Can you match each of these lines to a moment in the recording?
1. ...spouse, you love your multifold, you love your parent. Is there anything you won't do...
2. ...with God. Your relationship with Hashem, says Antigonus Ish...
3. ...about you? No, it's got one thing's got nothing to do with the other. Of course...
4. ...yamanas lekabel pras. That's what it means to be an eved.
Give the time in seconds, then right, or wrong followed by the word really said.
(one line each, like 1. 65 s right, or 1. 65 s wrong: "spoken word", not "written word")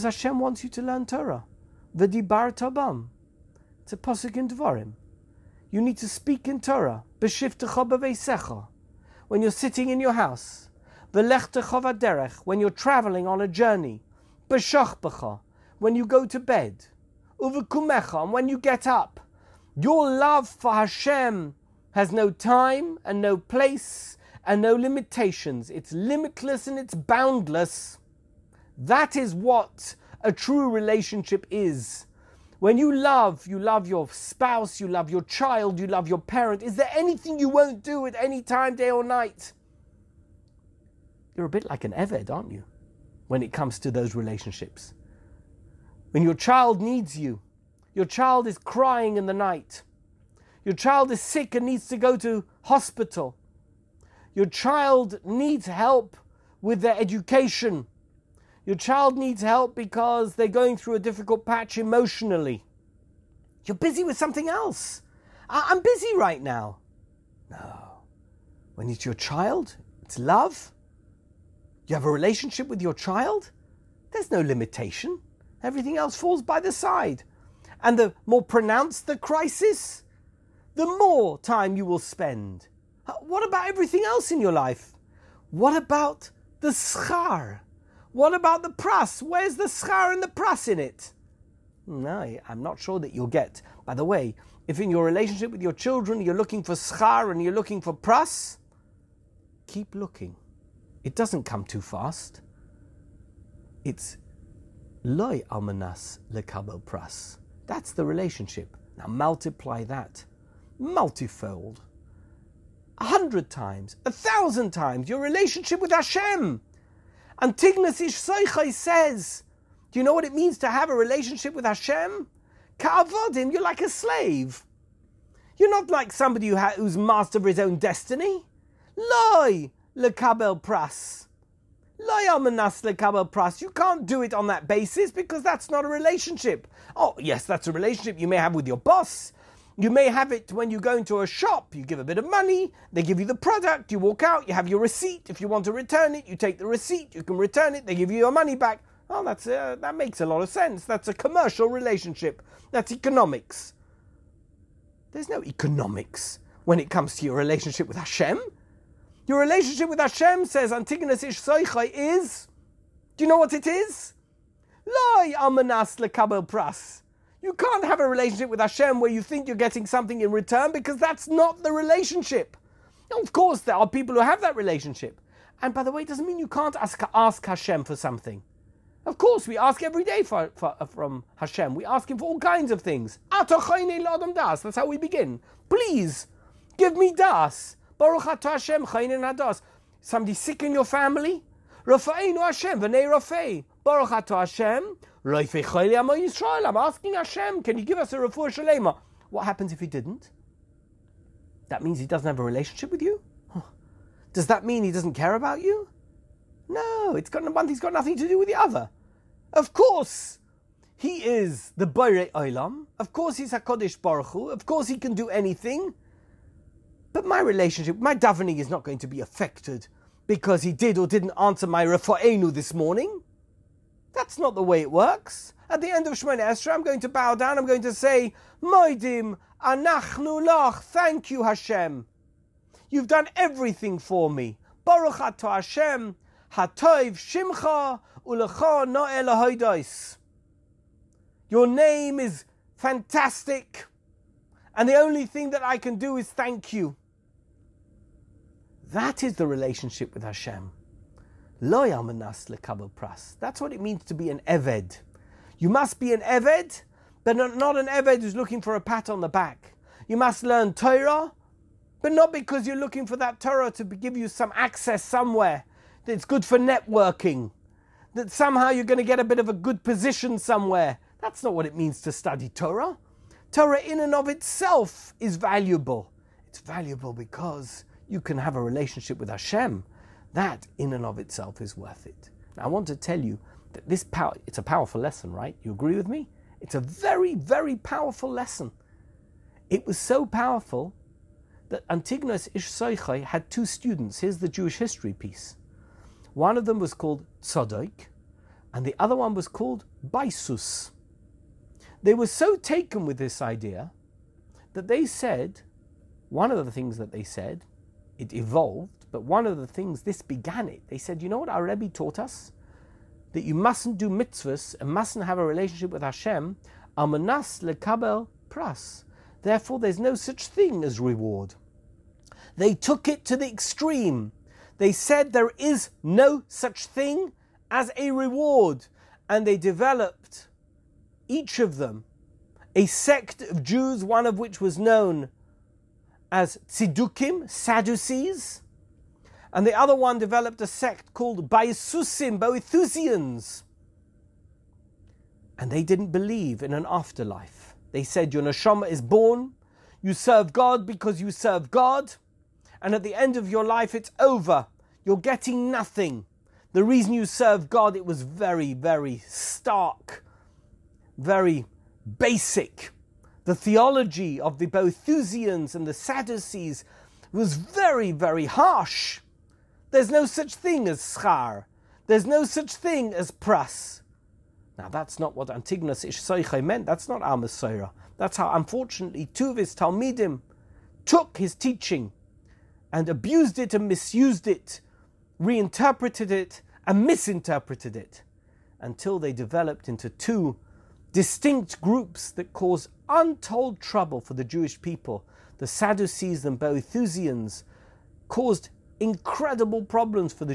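1. 34 s wrong: "child", not "multifold"
2. 157 s wrong: "Hashem", not "God"
3. 205 s right
4. 251 s right.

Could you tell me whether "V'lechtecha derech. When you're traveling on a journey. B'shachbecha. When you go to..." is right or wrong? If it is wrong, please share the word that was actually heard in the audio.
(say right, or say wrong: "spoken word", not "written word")
right.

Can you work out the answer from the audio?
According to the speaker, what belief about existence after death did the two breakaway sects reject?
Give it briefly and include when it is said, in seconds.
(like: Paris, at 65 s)
An afterlife, at 346 s.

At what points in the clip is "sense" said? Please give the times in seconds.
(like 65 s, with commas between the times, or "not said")
150 s.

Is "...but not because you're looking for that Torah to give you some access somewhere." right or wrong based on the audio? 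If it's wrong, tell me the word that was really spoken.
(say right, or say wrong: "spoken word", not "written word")
right.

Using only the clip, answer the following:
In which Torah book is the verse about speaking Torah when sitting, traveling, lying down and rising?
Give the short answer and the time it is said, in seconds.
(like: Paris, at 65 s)
Dvarim, at 4 s.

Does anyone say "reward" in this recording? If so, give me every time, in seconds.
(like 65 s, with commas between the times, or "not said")
321 s, 328 s.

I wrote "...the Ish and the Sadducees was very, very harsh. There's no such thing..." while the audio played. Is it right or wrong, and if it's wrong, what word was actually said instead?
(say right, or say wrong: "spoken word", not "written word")
wrong: "Boethusians", not "Ish".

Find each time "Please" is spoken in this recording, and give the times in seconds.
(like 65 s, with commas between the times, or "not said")
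185 s.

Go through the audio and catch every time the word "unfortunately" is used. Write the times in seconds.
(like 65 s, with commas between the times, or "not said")
378 s.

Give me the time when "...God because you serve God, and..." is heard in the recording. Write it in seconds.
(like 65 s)
350 s.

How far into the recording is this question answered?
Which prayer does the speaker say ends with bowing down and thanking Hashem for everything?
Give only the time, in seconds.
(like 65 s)
226 s.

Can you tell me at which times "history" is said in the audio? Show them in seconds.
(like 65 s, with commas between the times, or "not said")
294 s.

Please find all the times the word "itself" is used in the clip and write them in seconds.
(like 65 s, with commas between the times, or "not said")
274 s, 281 s.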